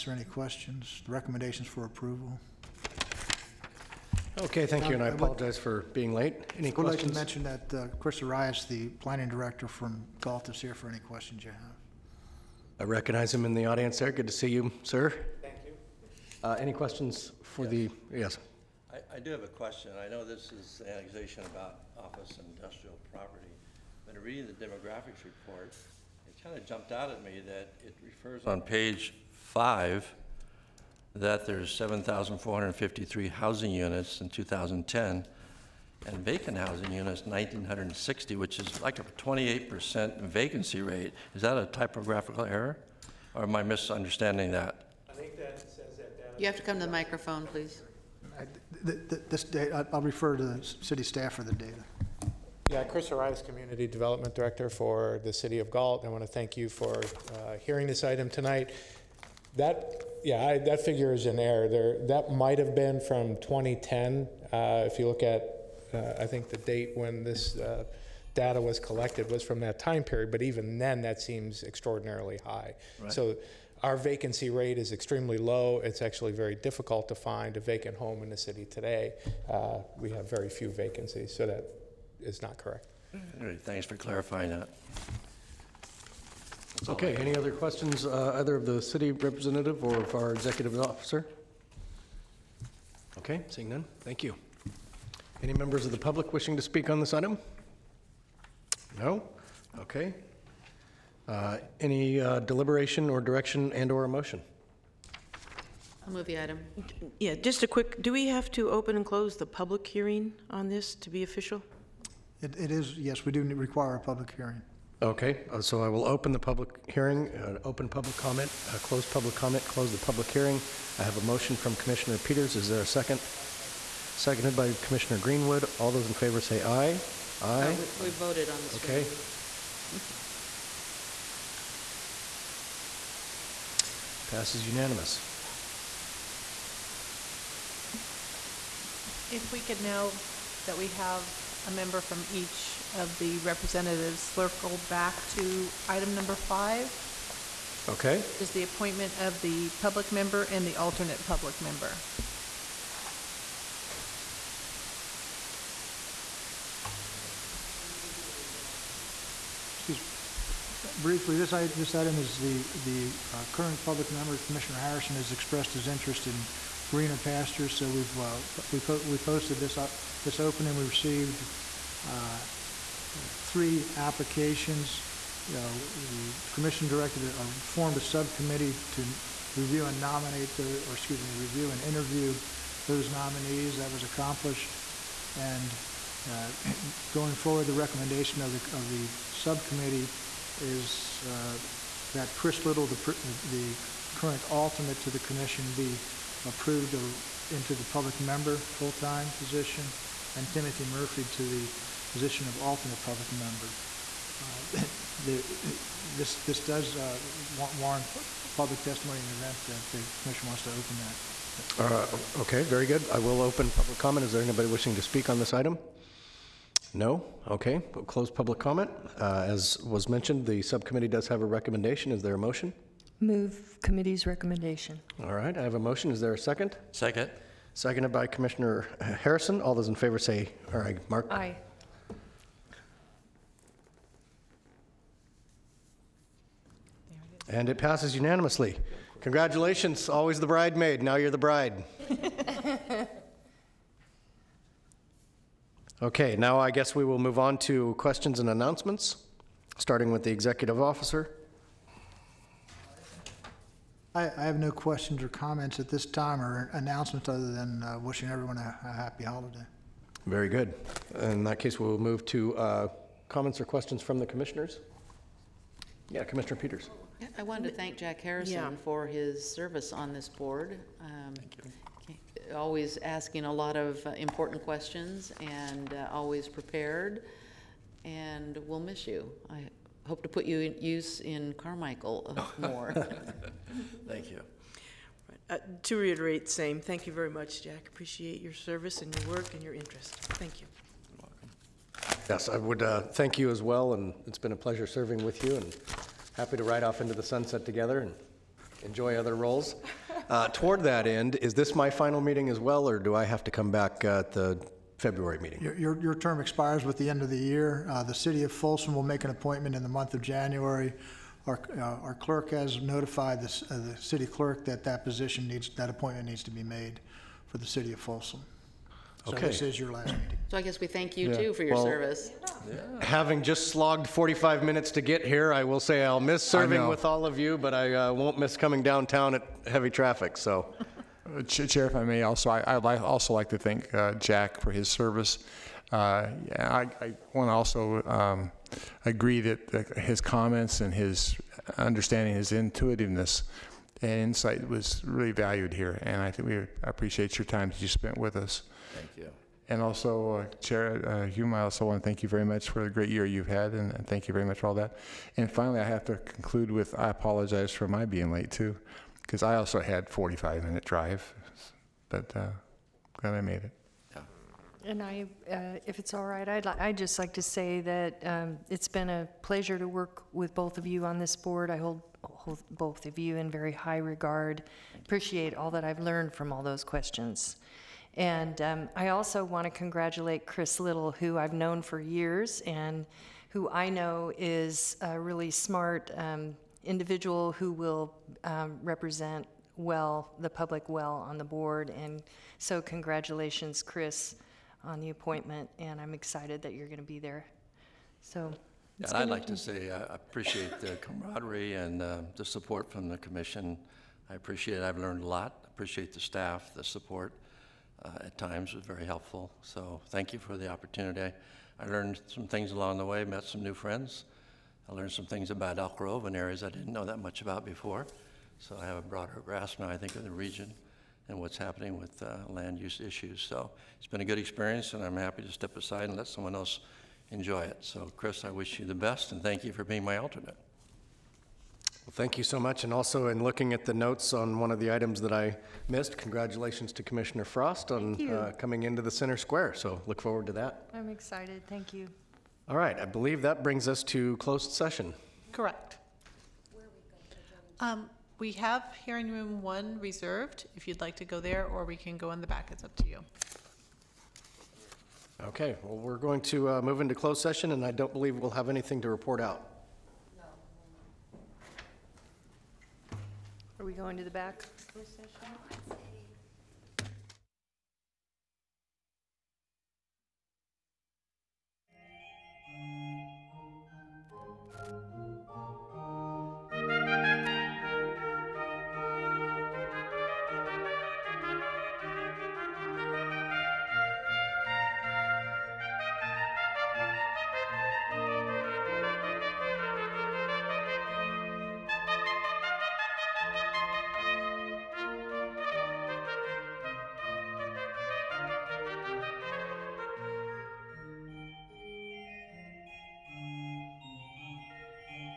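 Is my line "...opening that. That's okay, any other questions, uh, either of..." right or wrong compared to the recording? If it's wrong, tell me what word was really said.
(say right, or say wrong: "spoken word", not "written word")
wrong: "clarifying", not "opening".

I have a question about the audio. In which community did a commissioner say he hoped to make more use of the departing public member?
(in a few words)
Carmichael.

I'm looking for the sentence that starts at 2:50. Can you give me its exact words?
We received uh, uh, three applications.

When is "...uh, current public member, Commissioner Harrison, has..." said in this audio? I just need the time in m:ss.
2:43.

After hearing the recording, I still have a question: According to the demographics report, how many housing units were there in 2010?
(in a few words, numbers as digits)
7,453.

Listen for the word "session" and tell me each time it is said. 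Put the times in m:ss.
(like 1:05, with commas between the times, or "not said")
7:24, 7:37.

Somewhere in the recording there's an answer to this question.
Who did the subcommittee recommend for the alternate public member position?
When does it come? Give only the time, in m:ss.
3:20.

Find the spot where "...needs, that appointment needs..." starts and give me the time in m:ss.
5:15.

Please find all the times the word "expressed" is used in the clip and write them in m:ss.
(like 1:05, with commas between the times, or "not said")
2:45.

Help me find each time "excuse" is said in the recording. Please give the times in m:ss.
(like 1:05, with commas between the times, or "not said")
3:00.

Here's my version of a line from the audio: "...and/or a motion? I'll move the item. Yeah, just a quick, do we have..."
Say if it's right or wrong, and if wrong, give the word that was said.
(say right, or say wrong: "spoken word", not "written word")
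right.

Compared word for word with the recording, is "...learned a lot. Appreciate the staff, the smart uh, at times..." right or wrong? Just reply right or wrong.
wrong.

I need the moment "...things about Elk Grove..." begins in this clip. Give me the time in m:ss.
6:55.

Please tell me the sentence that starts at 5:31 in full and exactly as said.
Uh, Chair, if I may, also, I- I'd also like to thank uh, Jack for his service.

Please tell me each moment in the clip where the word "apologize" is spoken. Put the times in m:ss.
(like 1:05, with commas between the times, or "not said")
0:05, 5:57.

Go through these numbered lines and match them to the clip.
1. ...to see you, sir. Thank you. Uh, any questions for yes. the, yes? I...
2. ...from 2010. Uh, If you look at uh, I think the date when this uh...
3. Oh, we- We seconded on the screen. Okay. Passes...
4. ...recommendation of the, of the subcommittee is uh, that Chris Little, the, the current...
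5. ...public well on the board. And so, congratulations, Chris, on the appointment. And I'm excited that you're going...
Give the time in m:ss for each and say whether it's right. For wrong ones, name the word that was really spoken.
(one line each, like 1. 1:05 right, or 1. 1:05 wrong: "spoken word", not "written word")
1. 0:14 right
2. 1:03 right
3. 2:07 wrong: "voted", not "seconded"
4. 3:07 right
5. 6:30 right.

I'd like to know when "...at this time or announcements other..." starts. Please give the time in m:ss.
4:15.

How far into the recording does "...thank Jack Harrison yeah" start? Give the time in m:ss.
4:27.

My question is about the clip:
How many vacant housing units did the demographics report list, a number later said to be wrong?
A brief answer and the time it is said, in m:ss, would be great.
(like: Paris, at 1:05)
1,960, at 0:37.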